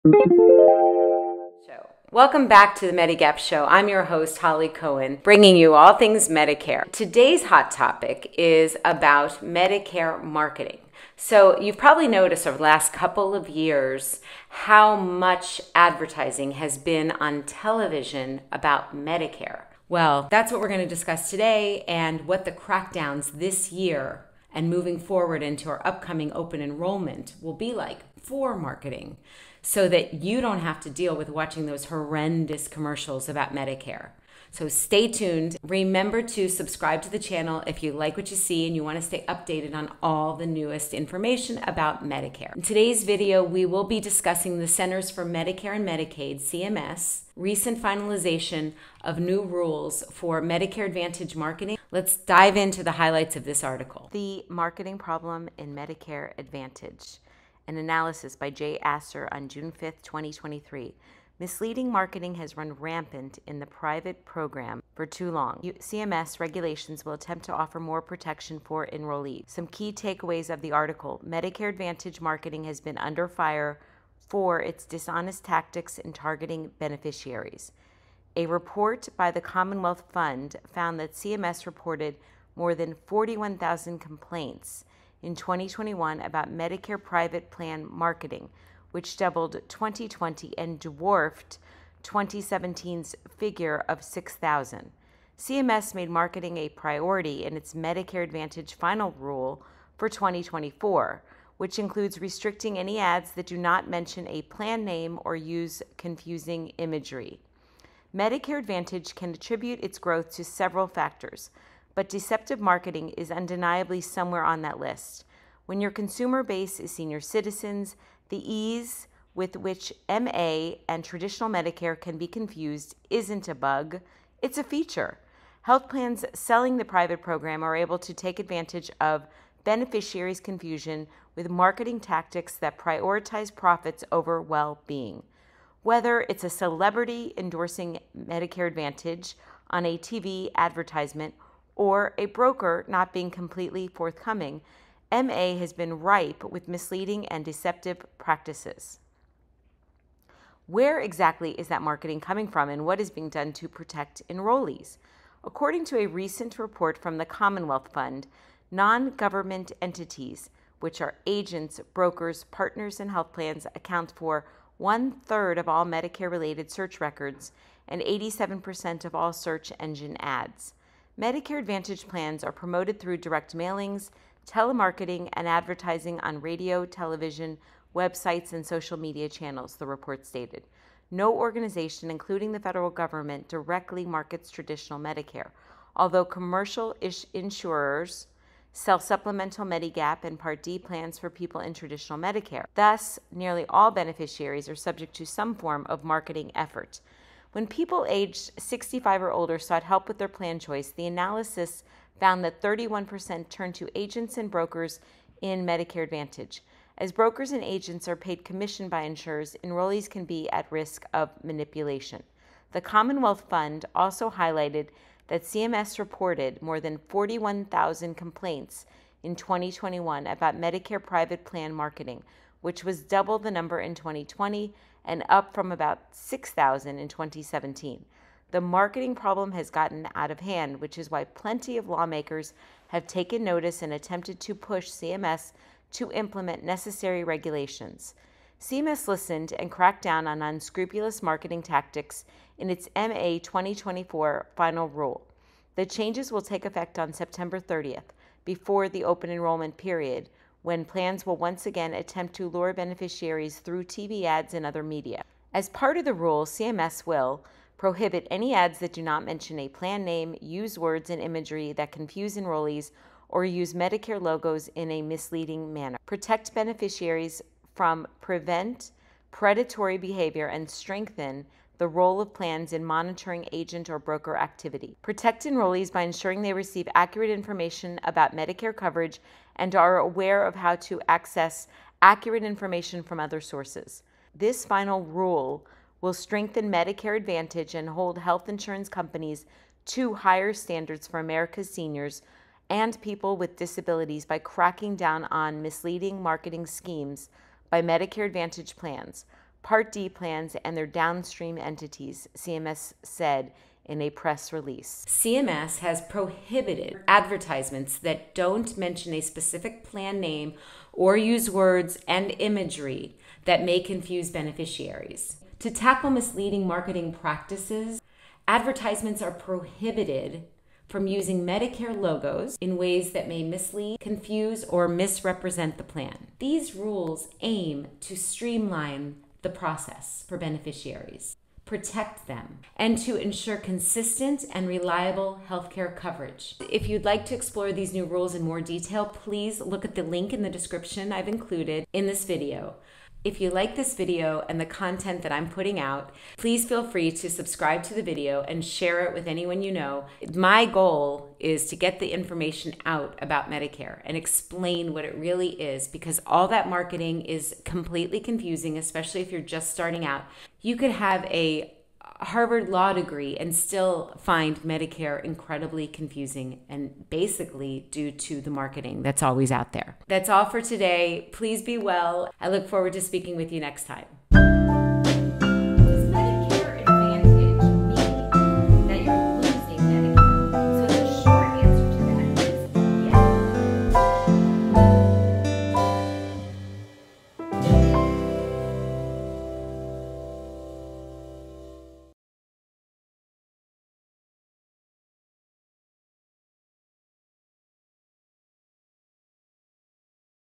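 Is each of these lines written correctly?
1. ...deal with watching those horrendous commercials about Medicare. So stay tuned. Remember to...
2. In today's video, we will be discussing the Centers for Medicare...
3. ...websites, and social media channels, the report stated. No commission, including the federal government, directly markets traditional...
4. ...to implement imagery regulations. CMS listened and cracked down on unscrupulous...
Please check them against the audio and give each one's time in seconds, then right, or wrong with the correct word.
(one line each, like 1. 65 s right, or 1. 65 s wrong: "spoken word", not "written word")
1. 30 s right
2. 42 s right
3. 177 s wrong: "organization", not "commission"
4. 235 s wrong: "necessary", not "imagery".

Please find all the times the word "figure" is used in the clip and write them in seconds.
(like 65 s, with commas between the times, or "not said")
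93 s.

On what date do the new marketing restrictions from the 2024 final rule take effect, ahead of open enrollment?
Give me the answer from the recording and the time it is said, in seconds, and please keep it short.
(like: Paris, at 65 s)
September 30th, at 247 s.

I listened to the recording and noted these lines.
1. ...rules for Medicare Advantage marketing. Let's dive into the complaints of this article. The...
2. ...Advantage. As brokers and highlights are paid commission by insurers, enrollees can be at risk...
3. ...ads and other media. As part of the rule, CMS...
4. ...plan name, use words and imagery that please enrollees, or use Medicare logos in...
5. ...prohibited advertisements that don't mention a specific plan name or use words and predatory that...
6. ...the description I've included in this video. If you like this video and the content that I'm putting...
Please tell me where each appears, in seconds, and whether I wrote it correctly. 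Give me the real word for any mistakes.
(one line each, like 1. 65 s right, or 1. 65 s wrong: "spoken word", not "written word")
1. 49 s wrong: "highlights", not "complaints"
2. 206 s wrong: "agents", not "highlights"
3. 254 s right
4. 259 s wrong: "confuse", not "please"
5. 306 s wrong: "imagery", not "predatory"
6. 340 s right.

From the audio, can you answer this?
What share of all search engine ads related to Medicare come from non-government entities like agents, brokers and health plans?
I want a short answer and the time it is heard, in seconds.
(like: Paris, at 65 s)
87%, at 168 s.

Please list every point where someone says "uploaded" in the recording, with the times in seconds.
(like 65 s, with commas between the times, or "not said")
not said.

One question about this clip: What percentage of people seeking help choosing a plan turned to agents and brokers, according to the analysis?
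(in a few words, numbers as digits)
31%.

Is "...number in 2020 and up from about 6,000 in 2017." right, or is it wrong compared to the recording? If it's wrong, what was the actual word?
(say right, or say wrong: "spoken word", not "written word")
right.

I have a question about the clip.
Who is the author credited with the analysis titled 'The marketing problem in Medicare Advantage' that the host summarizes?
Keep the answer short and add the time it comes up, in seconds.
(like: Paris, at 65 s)
Jay Asser, at 58 s.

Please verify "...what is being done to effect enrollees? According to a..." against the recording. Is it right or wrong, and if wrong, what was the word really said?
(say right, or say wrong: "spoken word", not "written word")
wrong: "protect", not "effect".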